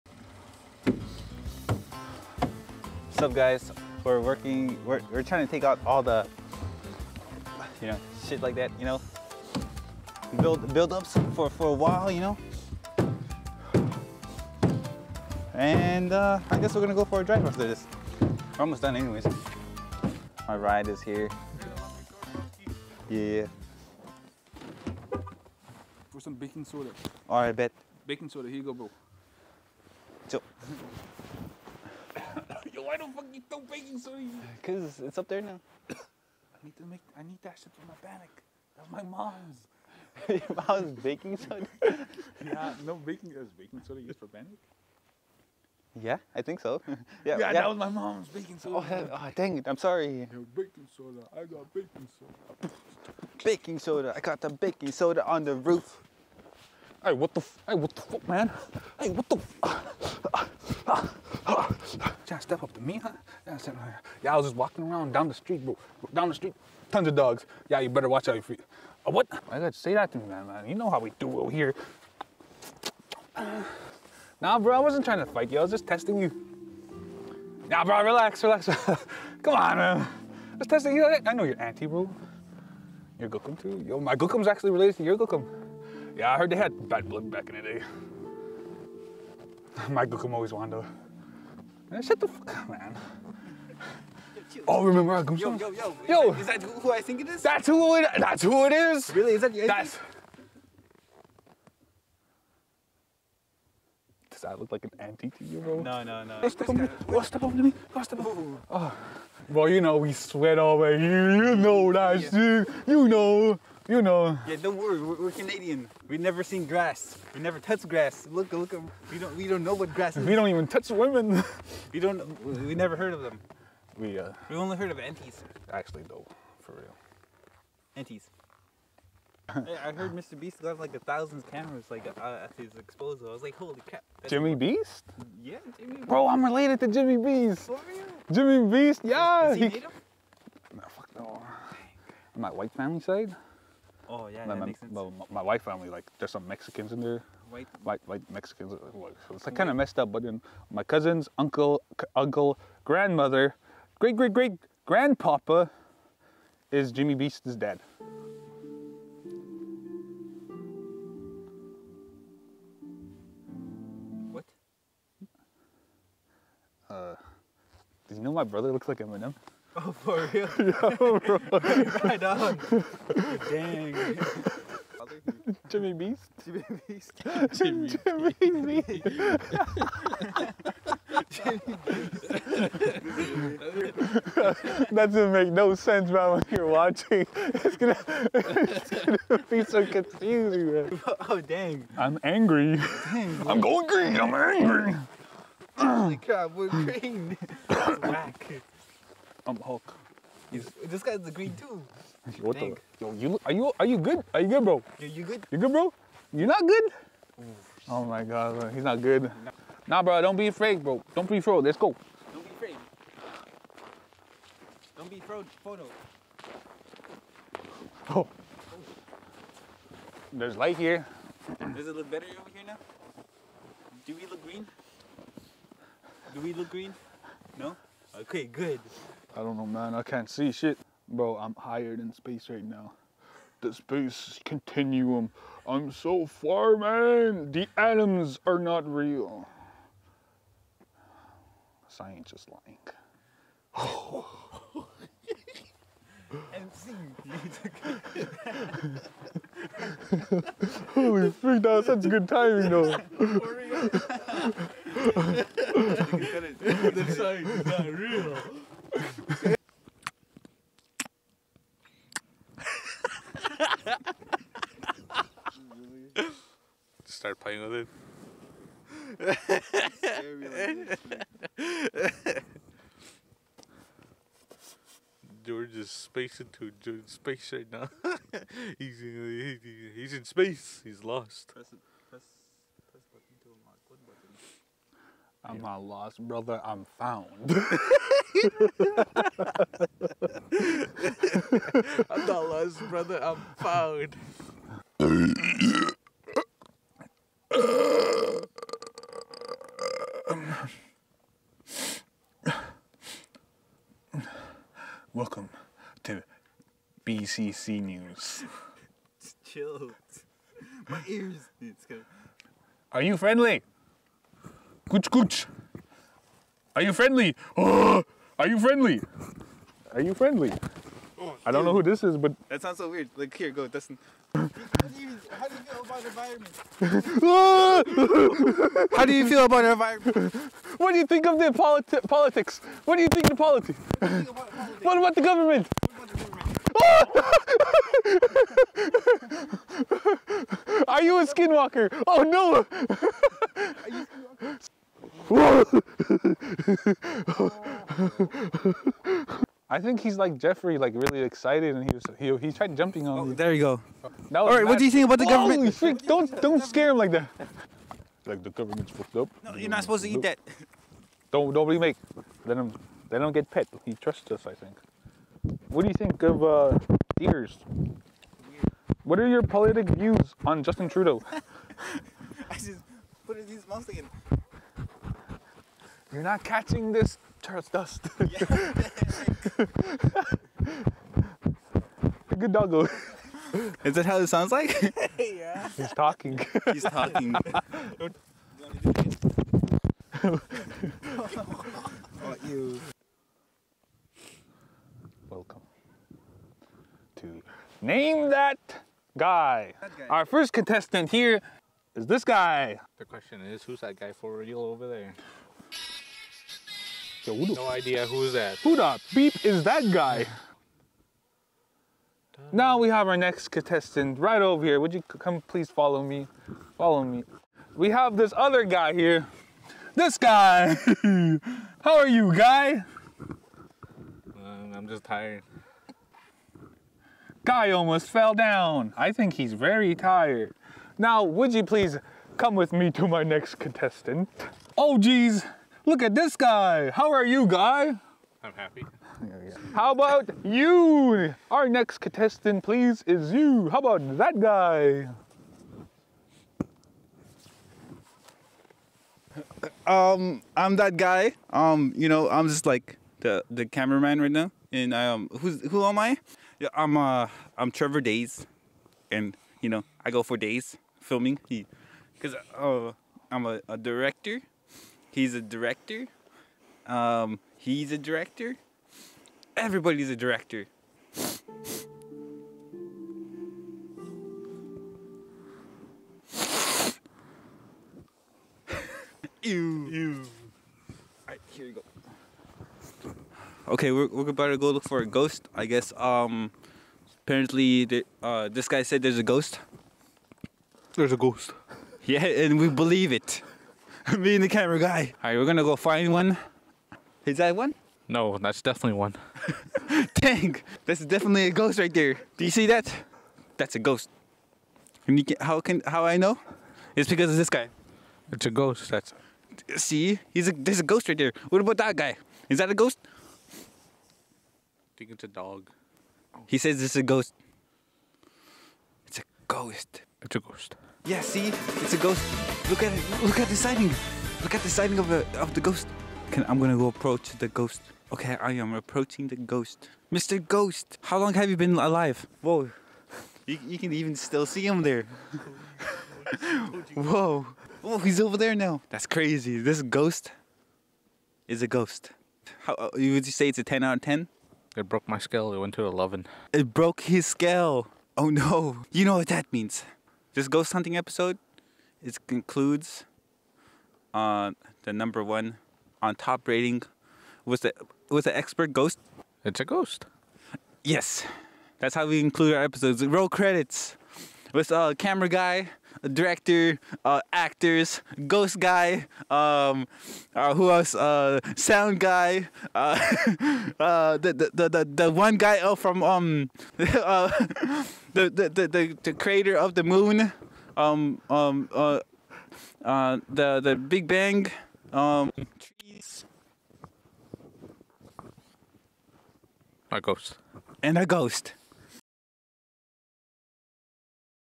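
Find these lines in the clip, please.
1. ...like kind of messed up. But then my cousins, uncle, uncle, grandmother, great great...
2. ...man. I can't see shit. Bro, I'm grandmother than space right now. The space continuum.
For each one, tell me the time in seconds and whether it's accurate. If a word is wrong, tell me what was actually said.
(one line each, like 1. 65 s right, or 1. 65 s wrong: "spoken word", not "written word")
1. 149 s right
2. 229 s wrong: "higher", not "grandmother".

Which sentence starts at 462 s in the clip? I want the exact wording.
Cause uh, I'm a, a director He's a director.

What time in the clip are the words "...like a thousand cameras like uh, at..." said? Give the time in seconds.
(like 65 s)
130 s.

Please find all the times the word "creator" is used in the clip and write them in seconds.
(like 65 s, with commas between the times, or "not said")
579 s.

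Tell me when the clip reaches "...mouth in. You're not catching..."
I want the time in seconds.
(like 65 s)
373 s.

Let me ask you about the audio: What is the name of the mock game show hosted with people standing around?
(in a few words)
Name That Guy.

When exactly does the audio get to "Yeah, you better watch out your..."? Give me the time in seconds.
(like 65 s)
67 s.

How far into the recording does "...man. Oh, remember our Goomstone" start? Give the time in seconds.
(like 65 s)
92 s.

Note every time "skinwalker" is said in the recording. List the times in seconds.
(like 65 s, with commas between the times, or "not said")
341 s, 345 s.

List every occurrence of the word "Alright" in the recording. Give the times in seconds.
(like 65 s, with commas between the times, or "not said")
27 s, 481 s.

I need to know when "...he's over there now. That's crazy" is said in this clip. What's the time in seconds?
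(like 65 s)
537 s.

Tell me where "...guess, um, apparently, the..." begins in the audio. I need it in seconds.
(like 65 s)
485 s.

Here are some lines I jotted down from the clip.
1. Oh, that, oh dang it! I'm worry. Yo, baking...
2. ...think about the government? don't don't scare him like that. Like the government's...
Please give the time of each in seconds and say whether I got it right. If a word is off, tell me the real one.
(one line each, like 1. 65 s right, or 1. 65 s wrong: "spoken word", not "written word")
1. 48 s wrong: "sorry", not "worry"
2. 354 s right.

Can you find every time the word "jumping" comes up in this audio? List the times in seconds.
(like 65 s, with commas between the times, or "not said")
352 s.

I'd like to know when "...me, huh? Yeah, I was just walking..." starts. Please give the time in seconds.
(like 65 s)
62 s.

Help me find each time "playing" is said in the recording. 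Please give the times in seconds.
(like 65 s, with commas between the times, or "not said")
267 s.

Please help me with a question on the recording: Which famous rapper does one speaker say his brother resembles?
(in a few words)
Eminem.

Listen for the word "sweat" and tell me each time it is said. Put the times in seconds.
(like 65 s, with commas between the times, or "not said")
110 s.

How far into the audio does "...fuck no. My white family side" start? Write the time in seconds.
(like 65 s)
140 s.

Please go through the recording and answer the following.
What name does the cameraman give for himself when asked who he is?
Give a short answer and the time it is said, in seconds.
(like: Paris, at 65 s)
Trevor Days, at 457 s.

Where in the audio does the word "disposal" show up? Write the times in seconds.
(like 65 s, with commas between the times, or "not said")
132 s.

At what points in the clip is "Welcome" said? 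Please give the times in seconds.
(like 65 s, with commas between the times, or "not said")
305 s, 395 s.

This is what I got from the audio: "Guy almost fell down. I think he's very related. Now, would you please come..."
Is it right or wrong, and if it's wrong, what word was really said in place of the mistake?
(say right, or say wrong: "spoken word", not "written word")
wrong: "tired", not "related".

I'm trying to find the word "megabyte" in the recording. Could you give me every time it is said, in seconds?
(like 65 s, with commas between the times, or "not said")
not said.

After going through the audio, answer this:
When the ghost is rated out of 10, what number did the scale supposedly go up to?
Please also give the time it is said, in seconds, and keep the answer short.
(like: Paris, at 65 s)
11, at 545 s.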